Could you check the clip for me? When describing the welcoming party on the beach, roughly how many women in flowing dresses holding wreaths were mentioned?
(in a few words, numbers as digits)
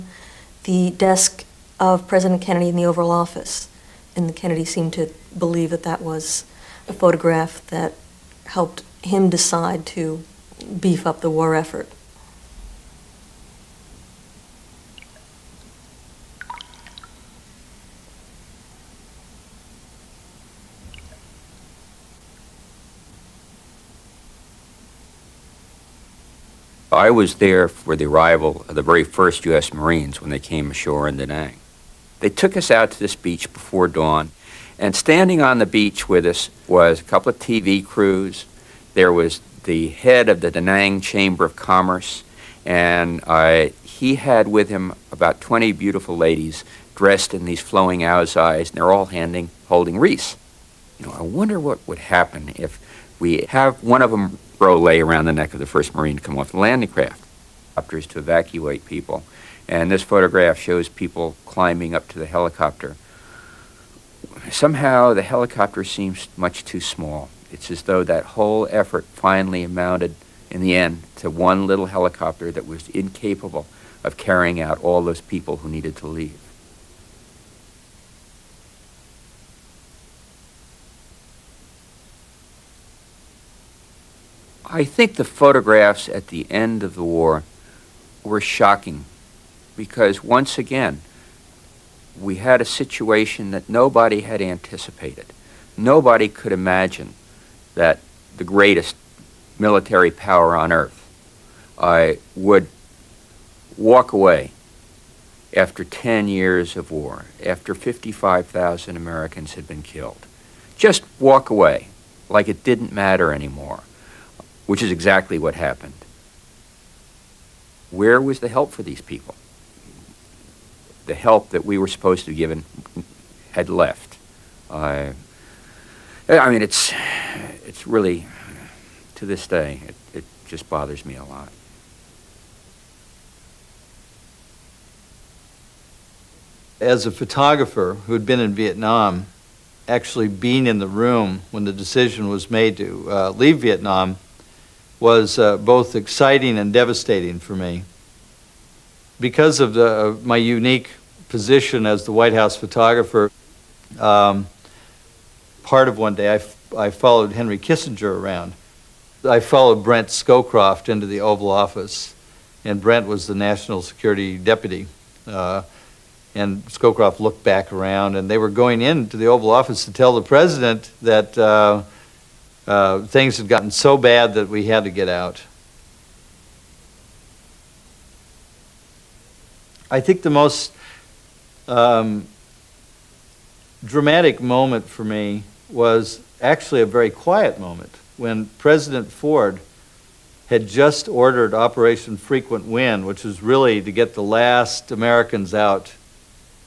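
20.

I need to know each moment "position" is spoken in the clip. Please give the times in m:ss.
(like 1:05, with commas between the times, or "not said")
2:31.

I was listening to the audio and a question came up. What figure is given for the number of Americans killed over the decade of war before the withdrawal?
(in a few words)
55,000.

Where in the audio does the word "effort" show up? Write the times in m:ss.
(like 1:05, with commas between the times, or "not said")
0:11, 1:08.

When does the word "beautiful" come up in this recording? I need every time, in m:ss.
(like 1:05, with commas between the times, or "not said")
0:45.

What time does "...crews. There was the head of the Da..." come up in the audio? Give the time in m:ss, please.
0:37.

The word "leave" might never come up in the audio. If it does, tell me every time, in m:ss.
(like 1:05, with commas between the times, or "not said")
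1:16, 2:23.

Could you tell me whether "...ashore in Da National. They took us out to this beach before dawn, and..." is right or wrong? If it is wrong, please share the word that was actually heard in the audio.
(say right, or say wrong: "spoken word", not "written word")
wrong: "Nang", not "National".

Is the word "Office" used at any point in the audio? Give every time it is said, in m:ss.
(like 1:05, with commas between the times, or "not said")
0:03, 2:41, 2:49.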